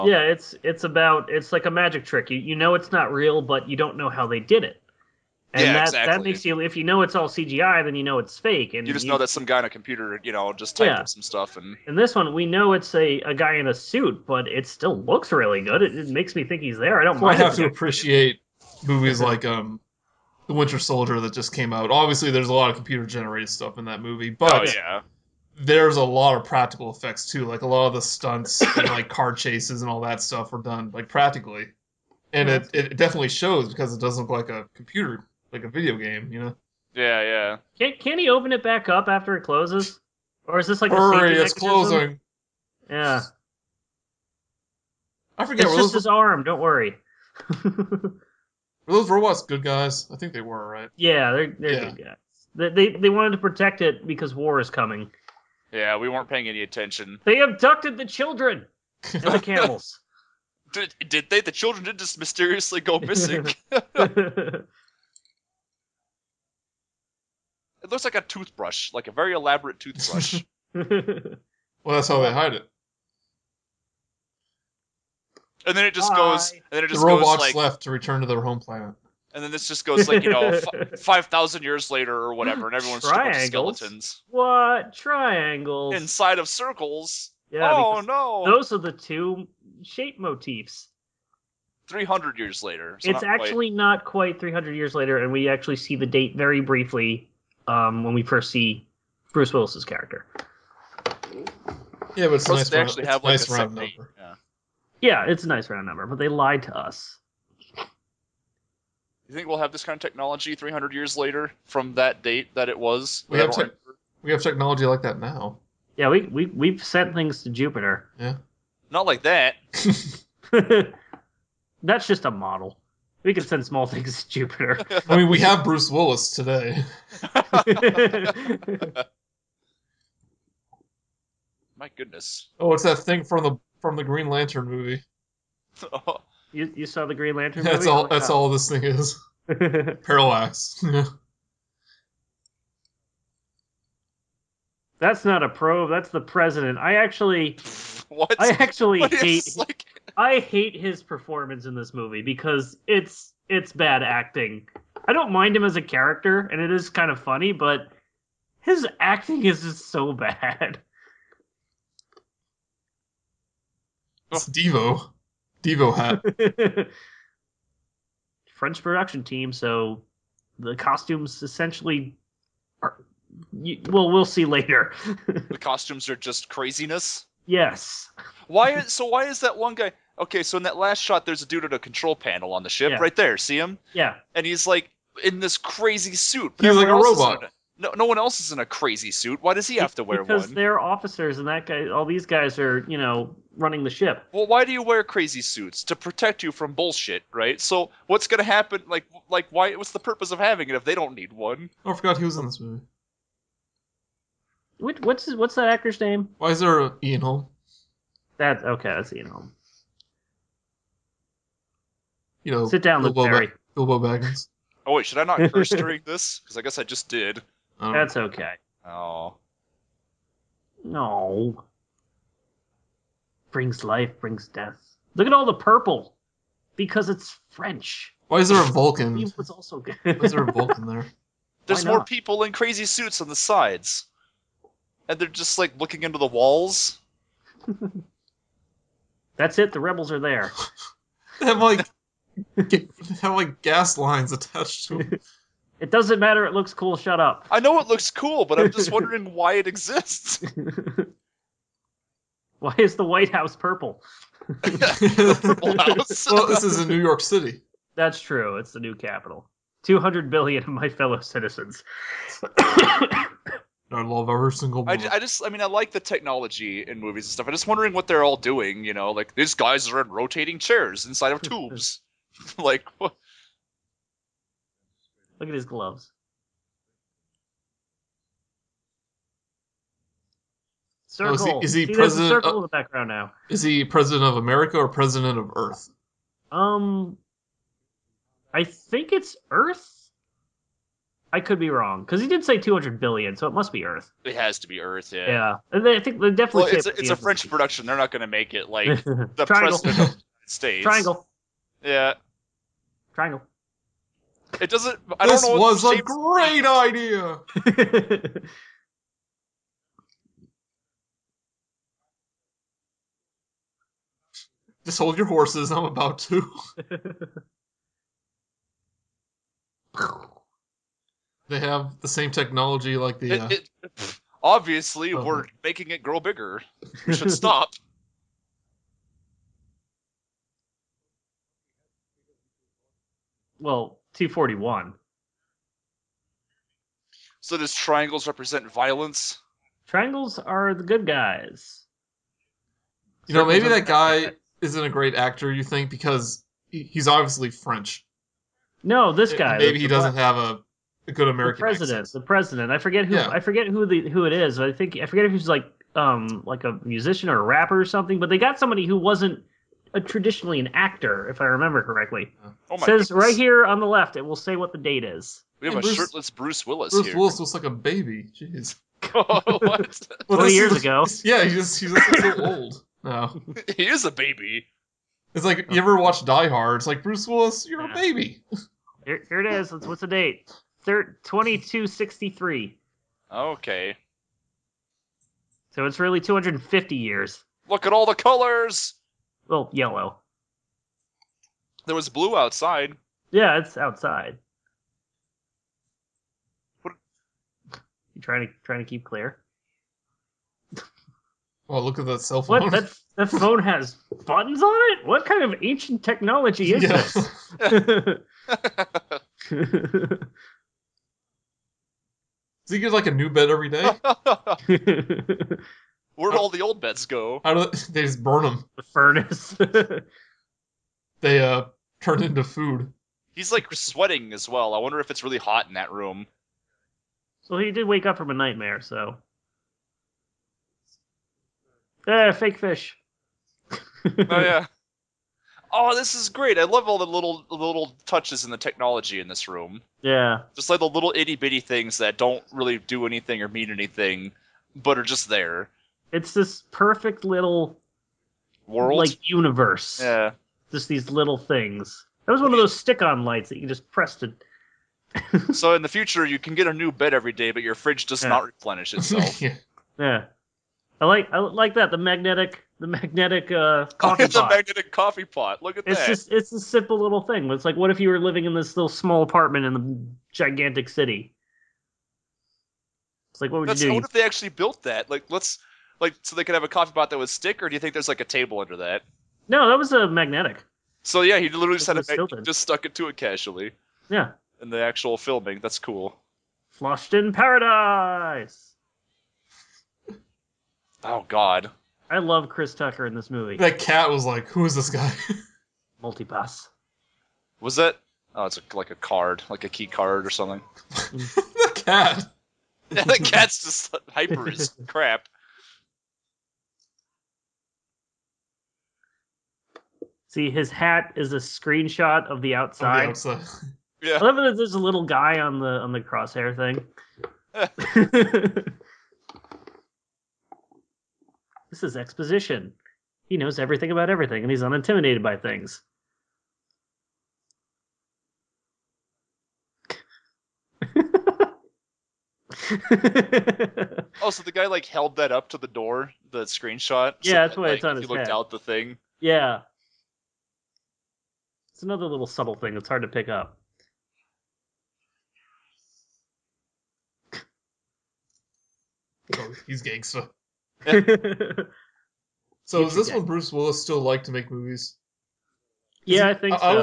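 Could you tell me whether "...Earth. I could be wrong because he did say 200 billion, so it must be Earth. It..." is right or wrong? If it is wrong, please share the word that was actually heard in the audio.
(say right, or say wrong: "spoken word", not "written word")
right.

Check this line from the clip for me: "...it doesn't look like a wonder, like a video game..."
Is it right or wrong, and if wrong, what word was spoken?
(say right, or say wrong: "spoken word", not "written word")
wrong: "computer", not "wonder".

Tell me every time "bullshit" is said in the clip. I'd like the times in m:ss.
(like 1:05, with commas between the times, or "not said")
3:16.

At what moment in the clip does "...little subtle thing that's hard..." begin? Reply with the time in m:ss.
9:02.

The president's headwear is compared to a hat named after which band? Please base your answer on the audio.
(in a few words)
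Devo hat.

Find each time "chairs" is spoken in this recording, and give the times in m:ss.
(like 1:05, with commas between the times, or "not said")
4:30.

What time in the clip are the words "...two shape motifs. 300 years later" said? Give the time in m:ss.
1:28.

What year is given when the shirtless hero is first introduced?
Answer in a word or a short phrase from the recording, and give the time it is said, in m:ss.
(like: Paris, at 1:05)
2263, at 6:20.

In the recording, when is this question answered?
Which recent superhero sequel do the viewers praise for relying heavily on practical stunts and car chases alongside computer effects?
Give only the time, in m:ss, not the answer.
0:20.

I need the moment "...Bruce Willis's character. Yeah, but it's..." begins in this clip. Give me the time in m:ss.
1:39.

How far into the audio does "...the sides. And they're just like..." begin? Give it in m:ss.
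3:53.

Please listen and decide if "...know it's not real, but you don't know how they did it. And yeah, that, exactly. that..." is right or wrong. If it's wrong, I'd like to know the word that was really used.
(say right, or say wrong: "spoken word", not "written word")
right.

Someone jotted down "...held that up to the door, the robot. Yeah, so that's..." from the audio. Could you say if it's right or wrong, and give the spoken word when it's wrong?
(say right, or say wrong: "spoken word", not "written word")
wrong: "screenshot", not "robot".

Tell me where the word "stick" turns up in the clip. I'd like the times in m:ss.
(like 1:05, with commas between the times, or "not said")
7:32, 7:57.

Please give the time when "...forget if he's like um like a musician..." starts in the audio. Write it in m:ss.
5:55.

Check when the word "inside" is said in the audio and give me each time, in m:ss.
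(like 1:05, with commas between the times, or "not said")
1:25, 4:31.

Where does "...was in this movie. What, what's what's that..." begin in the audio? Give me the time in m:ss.
3:22.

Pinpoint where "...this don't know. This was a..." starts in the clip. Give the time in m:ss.
5:05.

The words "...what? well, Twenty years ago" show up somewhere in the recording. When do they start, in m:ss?
6:09.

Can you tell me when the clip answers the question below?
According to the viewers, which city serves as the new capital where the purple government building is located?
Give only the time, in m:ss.
4:16.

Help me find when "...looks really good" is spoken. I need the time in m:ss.
0:15.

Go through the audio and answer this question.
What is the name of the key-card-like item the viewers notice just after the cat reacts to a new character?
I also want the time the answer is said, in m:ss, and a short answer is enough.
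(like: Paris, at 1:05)
Multipass, at 8:16.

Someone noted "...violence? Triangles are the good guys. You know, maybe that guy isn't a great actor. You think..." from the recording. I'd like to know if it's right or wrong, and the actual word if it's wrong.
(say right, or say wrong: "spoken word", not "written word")
right.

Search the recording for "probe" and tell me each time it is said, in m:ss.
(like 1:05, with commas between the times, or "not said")
2:25.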